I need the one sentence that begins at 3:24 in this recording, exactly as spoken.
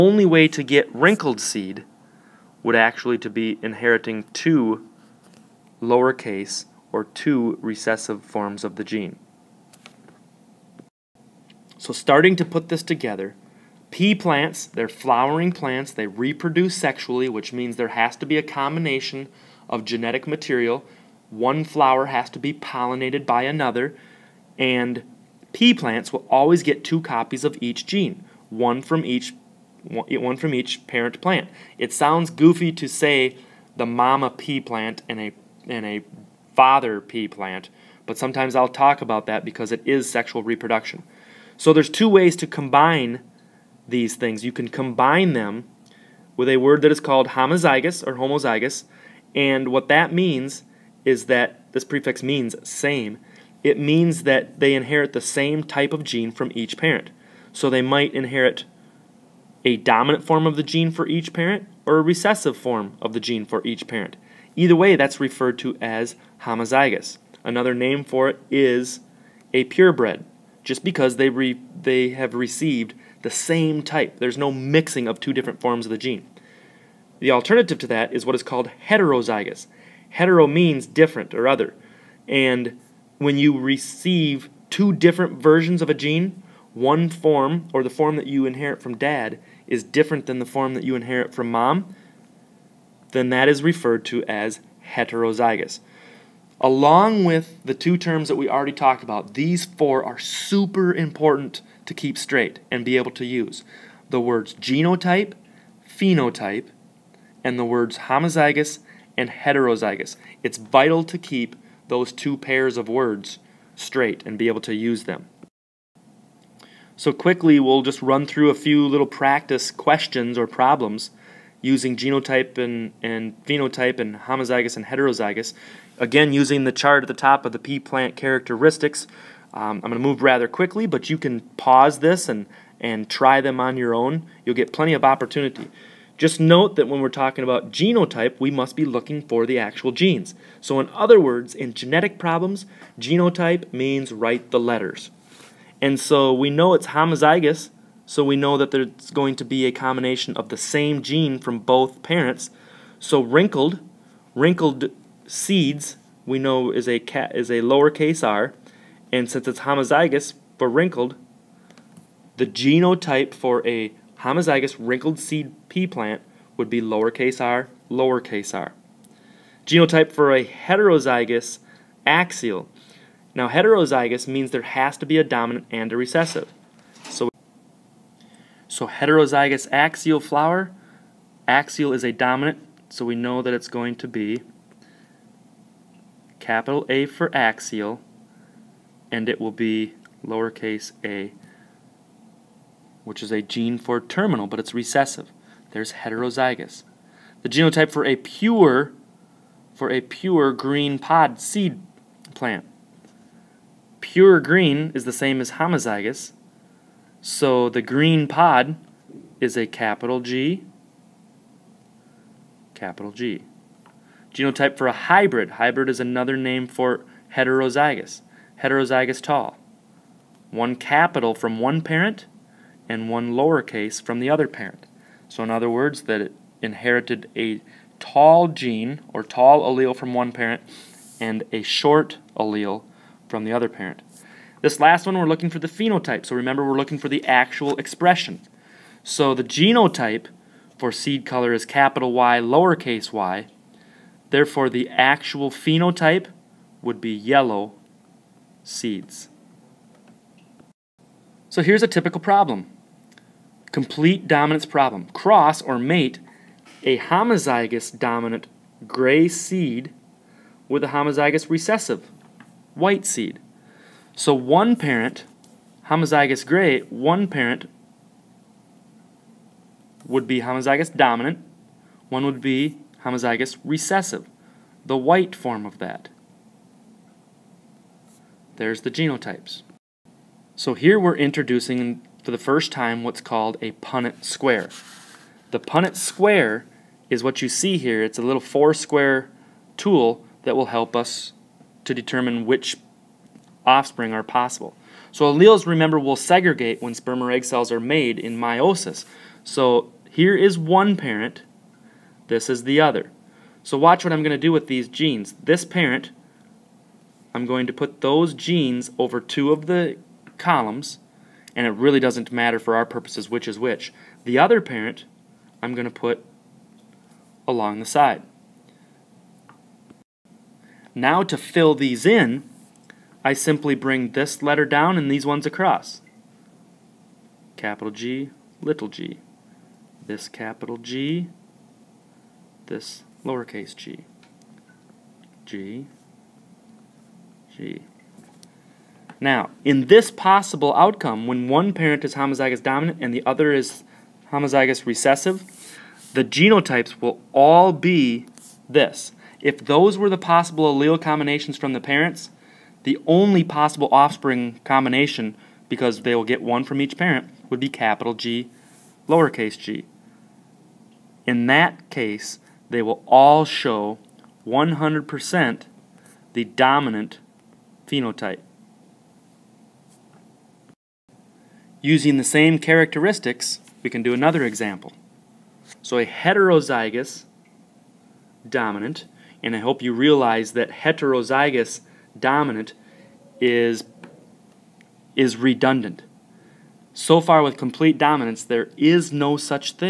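Pure green is the same as homozygous.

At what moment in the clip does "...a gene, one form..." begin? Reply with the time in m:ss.
1:25.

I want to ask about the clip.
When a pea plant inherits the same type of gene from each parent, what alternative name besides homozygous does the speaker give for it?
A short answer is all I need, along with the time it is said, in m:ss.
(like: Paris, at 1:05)
purebred, at 1:09.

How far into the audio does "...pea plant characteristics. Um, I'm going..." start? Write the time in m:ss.
2:07.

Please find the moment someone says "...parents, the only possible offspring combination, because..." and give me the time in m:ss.
5:51.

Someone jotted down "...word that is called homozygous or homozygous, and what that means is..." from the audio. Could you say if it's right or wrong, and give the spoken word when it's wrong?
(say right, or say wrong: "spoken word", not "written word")
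right.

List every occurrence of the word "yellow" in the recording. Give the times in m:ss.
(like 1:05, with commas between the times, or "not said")
4:07.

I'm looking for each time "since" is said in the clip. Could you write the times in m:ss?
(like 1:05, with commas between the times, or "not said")
2:39.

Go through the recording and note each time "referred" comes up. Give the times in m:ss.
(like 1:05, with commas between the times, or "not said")
1:05, 1:33.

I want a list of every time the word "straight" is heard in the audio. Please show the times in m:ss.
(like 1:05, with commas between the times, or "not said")
1:42, 1:53.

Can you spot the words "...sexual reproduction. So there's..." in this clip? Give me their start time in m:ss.
0:40.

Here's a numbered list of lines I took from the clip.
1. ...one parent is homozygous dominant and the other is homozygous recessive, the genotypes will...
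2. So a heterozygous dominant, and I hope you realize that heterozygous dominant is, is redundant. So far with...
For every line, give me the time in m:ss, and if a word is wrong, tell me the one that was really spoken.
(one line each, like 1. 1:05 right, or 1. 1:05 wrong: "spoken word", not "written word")
1. 5:41 right
2. 6:15 right.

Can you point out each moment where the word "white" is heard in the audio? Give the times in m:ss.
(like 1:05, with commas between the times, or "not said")
4:22, 4:34.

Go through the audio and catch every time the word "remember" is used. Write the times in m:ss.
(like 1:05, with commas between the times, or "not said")
3:56, 4:55.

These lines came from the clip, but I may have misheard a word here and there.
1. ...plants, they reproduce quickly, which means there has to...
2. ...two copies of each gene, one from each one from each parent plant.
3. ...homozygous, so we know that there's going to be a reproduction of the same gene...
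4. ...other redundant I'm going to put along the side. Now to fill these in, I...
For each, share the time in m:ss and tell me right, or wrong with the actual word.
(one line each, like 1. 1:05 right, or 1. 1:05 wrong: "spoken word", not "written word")
1. 0:15 wrong: "sexually", not "quickly"
2. 0:26 right
3. 2:26 wrong: "combination", not "reproduction"
4. 5:14 wrong: "parent", not "redundant".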